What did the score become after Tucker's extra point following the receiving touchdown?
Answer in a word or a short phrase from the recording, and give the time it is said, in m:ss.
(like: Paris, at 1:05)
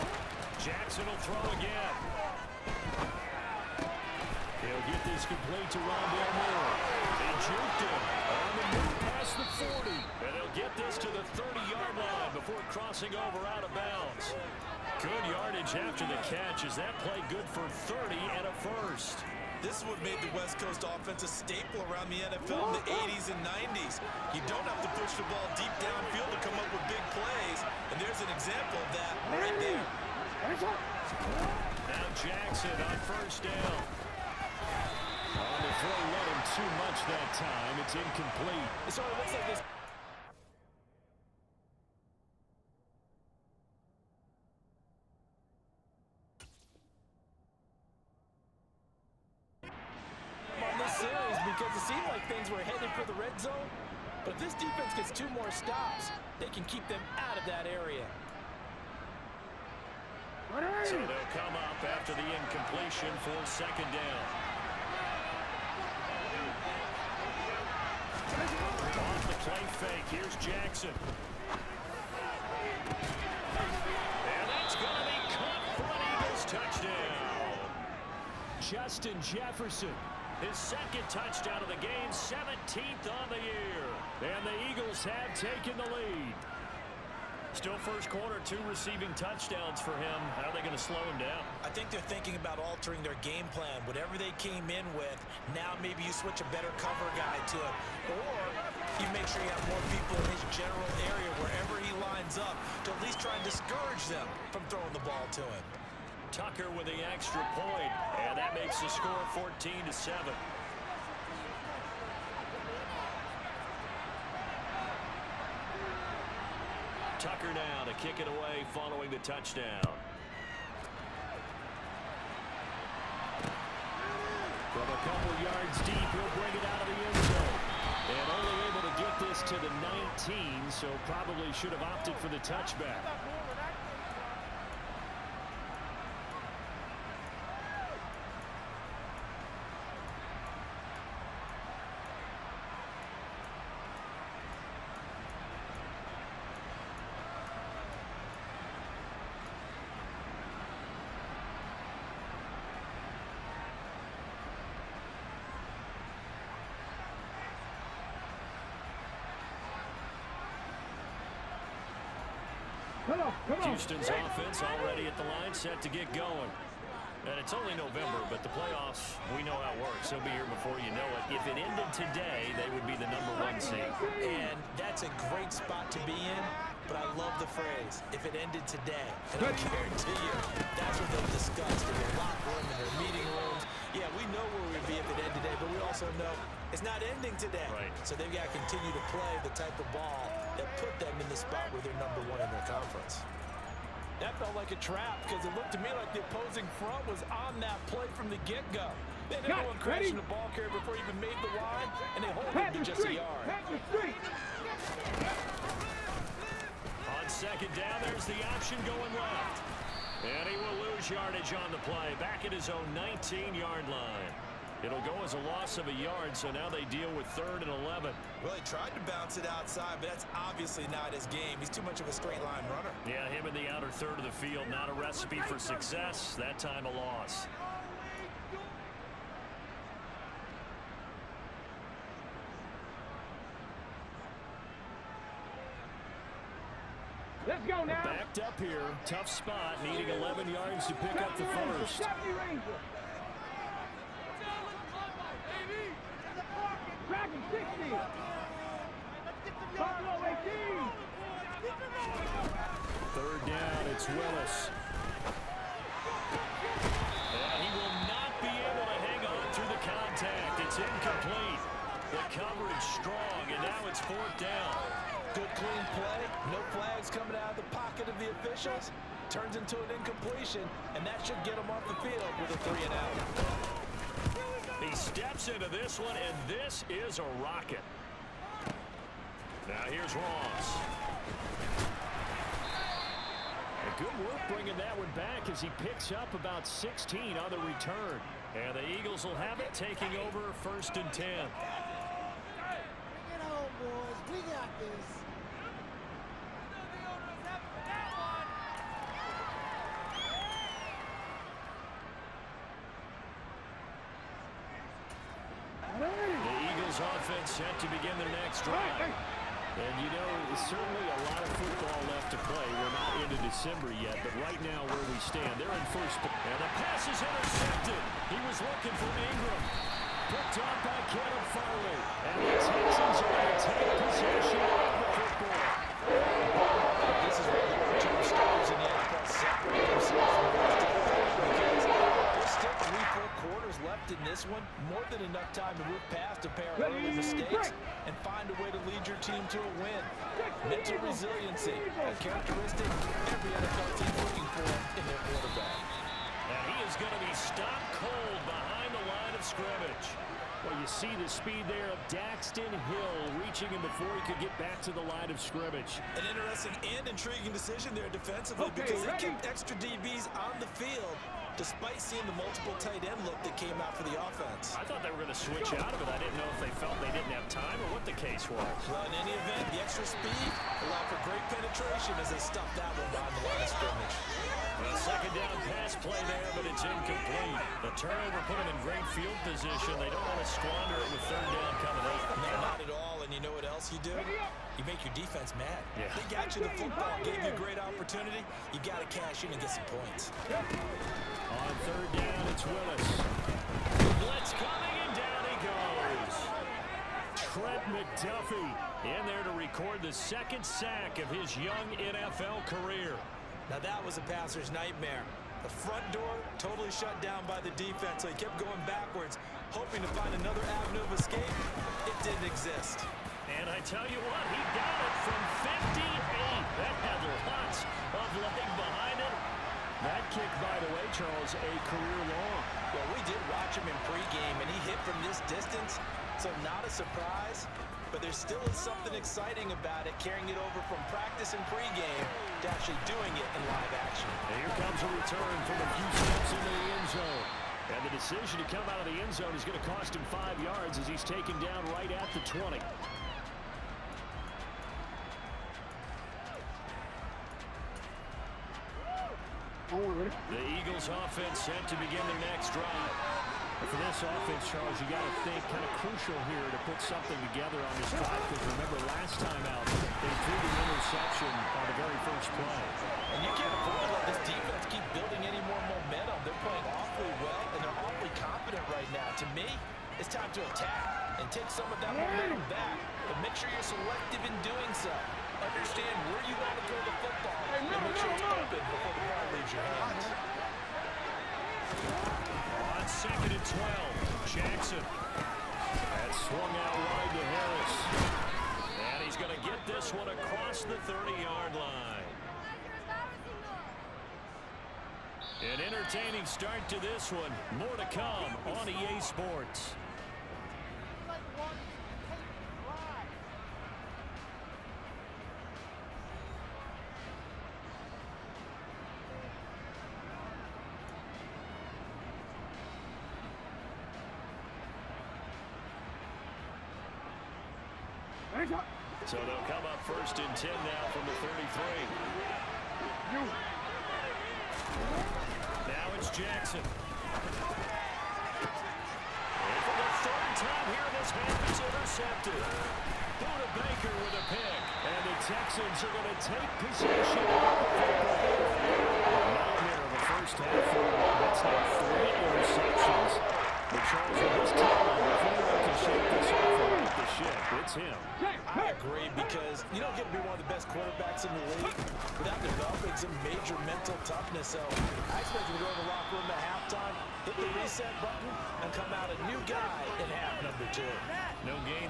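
14 to 7, at 1:49.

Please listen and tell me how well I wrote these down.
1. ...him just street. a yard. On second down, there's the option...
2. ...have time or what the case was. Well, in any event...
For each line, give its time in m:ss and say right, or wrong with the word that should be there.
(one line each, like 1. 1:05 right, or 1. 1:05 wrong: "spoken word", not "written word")
1. 3:22 right
2. 6:07 right.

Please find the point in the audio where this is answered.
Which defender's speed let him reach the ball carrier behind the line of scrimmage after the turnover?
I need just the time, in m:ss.
5:52.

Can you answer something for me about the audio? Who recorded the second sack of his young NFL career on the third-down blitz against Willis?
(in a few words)
Trent McDuffie.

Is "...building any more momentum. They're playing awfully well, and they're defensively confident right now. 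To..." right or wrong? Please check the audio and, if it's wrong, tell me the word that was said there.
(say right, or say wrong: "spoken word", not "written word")
wrong: "awfully", not "defensively".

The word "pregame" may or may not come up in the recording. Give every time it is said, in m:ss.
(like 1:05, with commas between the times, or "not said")
7:04, 7:11.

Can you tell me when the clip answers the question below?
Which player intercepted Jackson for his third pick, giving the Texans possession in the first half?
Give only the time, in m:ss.
8:53.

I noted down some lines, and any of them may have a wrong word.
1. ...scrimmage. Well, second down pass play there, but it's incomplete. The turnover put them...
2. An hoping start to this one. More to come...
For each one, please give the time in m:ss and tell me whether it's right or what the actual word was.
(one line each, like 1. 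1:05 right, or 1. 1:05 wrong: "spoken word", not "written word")
1. 6:13 right
2. 8:15 wrong: "entertaining", not "hoping".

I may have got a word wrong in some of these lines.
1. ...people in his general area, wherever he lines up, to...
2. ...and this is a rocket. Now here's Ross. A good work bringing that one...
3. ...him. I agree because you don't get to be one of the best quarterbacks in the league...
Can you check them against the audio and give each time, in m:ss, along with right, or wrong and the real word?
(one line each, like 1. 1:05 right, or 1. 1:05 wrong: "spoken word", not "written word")
1. 1:39 right
2. 4:36 right
3. 9:07 right.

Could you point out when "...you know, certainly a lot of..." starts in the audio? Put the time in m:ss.
5:10.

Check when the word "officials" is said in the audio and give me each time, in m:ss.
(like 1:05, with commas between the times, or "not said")
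4:28.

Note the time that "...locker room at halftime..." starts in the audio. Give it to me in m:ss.
9:16.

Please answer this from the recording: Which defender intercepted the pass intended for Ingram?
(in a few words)
Kevin Farley.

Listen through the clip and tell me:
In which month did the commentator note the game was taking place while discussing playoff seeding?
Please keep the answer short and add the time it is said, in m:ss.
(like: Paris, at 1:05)
November, at 2:47.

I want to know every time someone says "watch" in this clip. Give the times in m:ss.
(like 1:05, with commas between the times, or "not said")
7:03.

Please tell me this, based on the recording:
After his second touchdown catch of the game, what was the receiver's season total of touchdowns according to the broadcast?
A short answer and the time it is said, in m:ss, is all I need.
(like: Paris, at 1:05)
17th, at 1:22.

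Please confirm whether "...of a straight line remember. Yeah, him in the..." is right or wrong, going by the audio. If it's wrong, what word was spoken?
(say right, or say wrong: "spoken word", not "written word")
wrong: "runner", not "remember".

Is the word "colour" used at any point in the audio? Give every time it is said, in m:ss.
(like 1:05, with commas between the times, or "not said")
not said.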